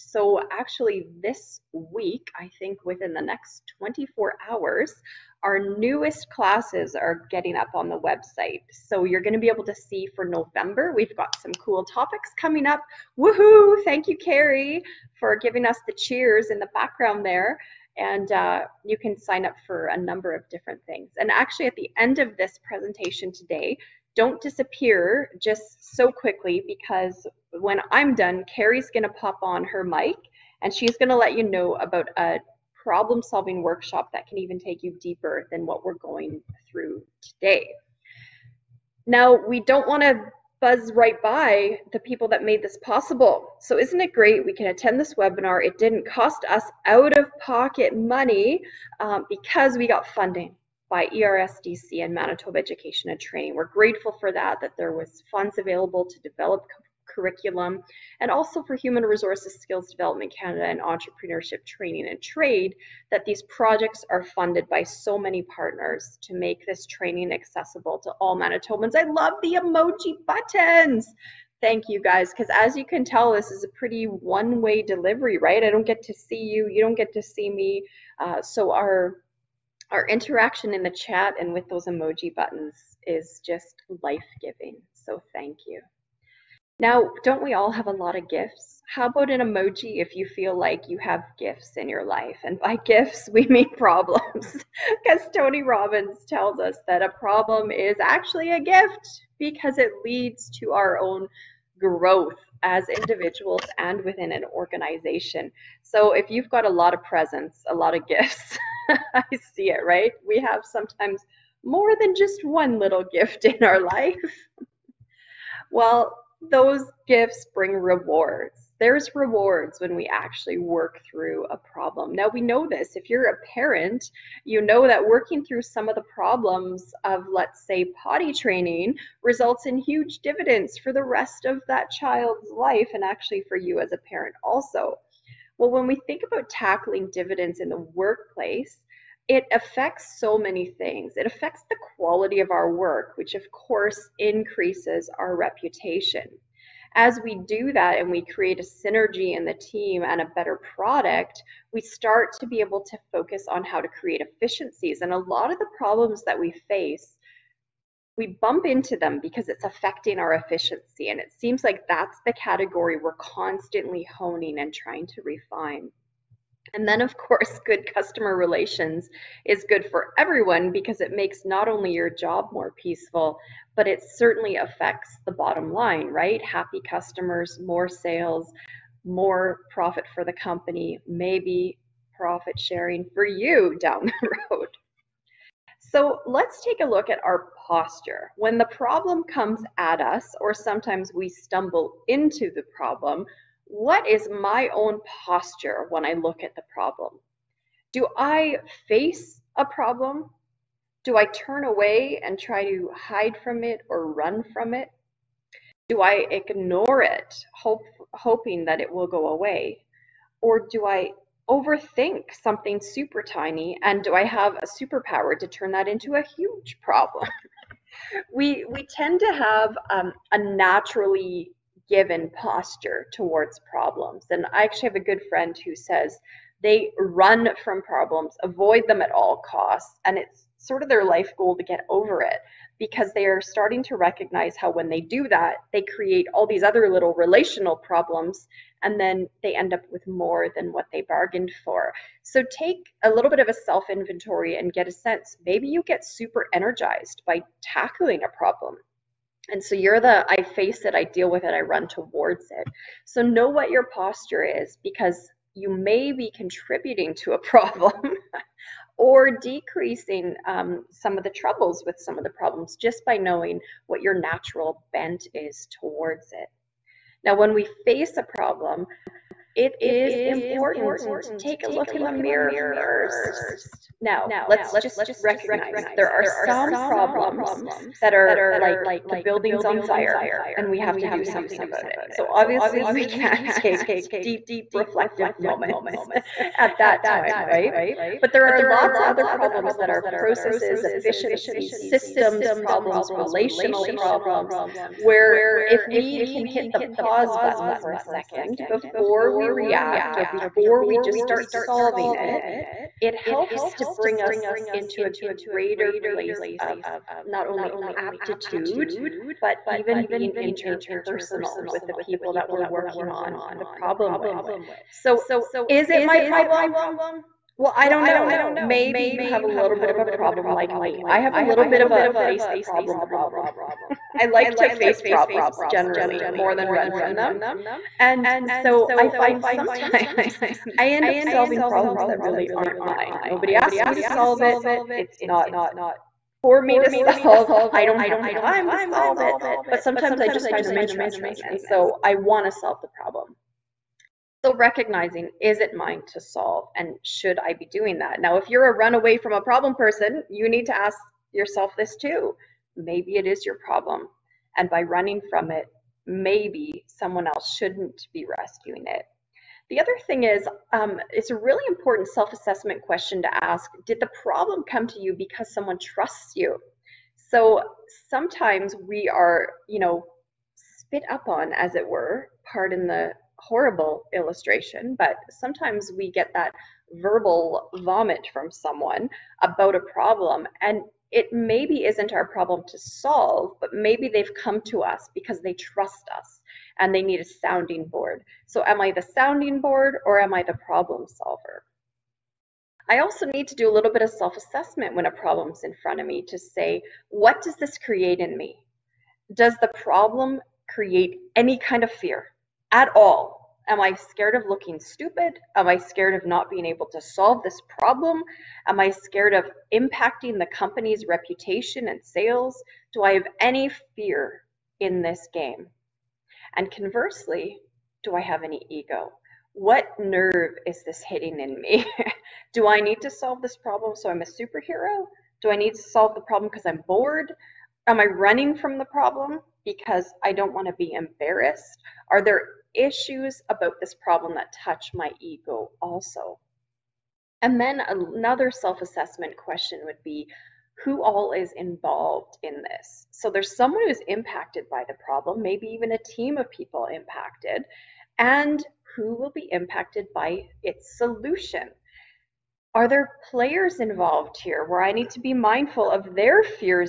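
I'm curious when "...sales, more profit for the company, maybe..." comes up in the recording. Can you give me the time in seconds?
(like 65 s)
177 s.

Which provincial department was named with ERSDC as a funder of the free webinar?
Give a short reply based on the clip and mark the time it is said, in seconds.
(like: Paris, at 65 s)
Manitoba Education and Training, at 52 s.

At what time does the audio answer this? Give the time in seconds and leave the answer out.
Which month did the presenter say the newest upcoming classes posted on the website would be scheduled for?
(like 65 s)
10 s.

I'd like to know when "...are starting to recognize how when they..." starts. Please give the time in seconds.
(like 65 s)
233 s.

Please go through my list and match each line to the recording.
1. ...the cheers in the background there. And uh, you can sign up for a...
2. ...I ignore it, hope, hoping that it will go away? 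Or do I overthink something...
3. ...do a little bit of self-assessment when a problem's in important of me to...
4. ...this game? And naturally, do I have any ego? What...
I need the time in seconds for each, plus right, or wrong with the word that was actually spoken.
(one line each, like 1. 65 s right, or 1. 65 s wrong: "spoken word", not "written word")
1. 15 s right
2. 206 s right
3. 393 s wrong: "front", not "important"
4. 415 s wrong: "conversely", not "naturally".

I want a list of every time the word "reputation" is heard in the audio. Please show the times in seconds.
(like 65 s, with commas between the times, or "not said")
145 s, 411 s.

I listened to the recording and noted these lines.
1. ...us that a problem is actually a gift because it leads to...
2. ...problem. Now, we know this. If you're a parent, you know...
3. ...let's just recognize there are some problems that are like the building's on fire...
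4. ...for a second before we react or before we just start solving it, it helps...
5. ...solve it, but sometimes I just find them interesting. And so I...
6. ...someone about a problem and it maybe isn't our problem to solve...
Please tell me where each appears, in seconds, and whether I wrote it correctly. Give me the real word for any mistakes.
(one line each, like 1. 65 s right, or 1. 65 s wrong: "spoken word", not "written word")
1. 96 s right
2. 121 s right
3. 274 s right
4. 297 s right
5. 338 s right
6. 378 s right.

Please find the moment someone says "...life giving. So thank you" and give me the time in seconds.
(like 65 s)
84 s.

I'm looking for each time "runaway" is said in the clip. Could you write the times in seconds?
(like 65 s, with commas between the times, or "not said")
348 s.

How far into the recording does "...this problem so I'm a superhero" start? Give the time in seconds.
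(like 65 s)
423 s.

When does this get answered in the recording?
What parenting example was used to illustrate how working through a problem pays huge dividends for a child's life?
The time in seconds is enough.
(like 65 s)
128 s.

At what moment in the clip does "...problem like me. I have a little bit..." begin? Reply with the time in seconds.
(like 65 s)
320 s.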